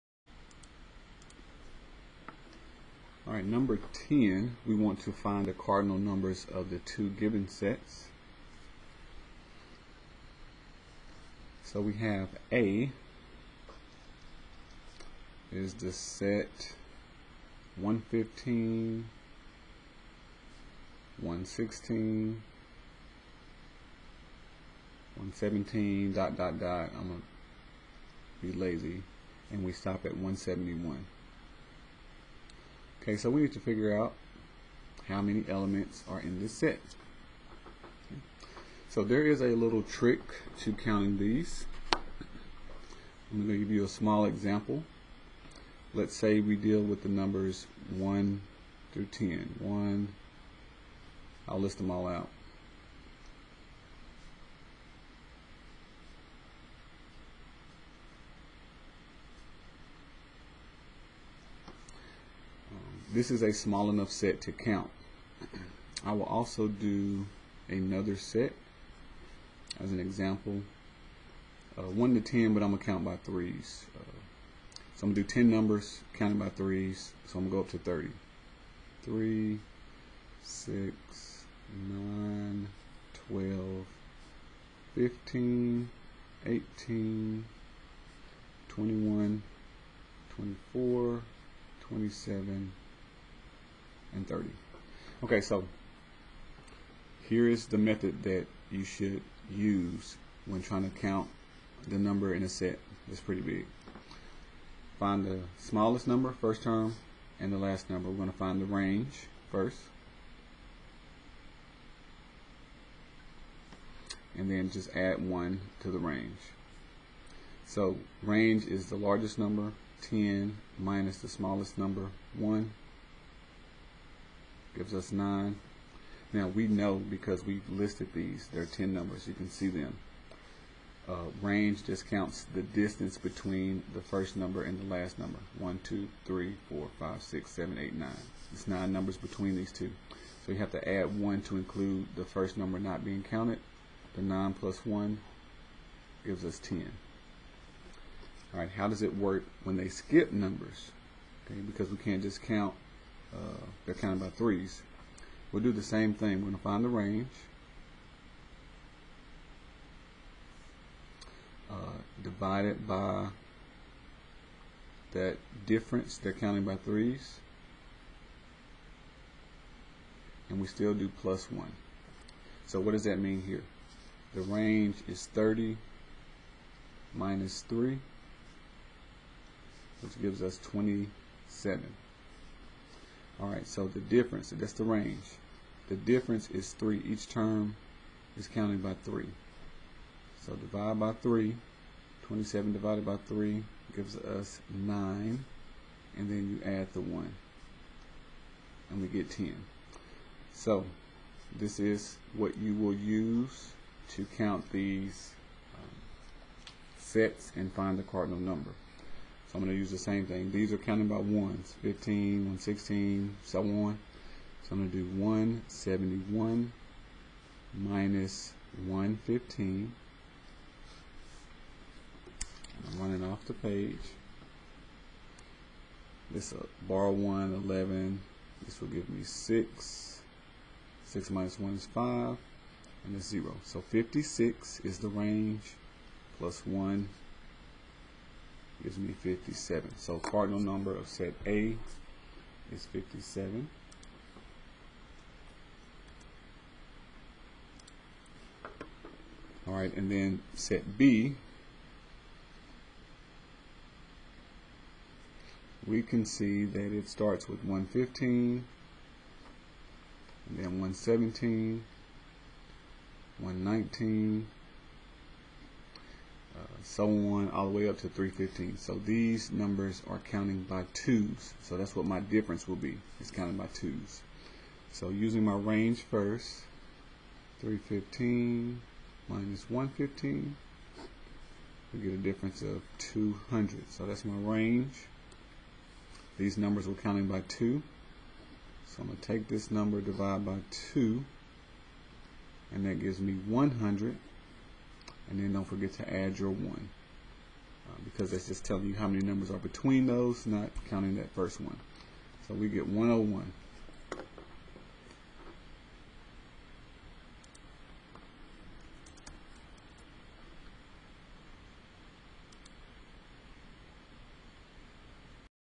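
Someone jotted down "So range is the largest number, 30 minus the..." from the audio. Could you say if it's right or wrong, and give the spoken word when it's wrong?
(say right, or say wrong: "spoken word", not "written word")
wrong: "10", not "30".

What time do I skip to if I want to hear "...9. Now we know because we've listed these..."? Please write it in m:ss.
2:05.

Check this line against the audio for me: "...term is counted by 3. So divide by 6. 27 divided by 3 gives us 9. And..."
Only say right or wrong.
wrong.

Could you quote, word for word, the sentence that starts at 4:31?
So that's what my difference will be.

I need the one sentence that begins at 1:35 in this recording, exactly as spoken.
Okay, so here is the method that you should use when trying to count the number in a set that's pretty big.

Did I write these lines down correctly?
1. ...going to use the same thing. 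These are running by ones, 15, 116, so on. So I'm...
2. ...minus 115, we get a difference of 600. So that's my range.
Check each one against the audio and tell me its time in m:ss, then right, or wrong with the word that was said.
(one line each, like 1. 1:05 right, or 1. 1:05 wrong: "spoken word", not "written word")
1. 3:29 wrong: "counting", not "running"
2. 4:39 wrong: "200", not "600".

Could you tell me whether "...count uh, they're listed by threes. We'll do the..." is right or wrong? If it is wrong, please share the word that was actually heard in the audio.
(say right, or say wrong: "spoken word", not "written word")
wrong: "counted", not "listed".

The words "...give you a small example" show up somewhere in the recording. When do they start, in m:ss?
0:43.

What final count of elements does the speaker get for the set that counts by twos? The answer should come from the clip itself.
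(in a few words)
101.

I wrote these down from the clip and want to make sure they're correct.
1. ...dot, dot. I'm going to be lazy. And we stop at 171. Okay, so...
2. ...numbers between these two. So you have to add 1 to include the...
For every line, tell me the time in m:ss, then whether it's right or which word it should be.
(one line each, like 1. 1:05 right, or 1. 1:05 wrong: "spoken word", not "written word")
1. 0:26 right
2. 2:18 right.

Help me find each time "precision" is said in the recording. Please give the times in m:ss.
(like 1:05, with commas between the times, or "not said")
not said.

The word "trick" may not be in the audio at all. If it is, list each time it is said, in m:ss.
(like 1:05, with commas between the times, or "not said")
0:39.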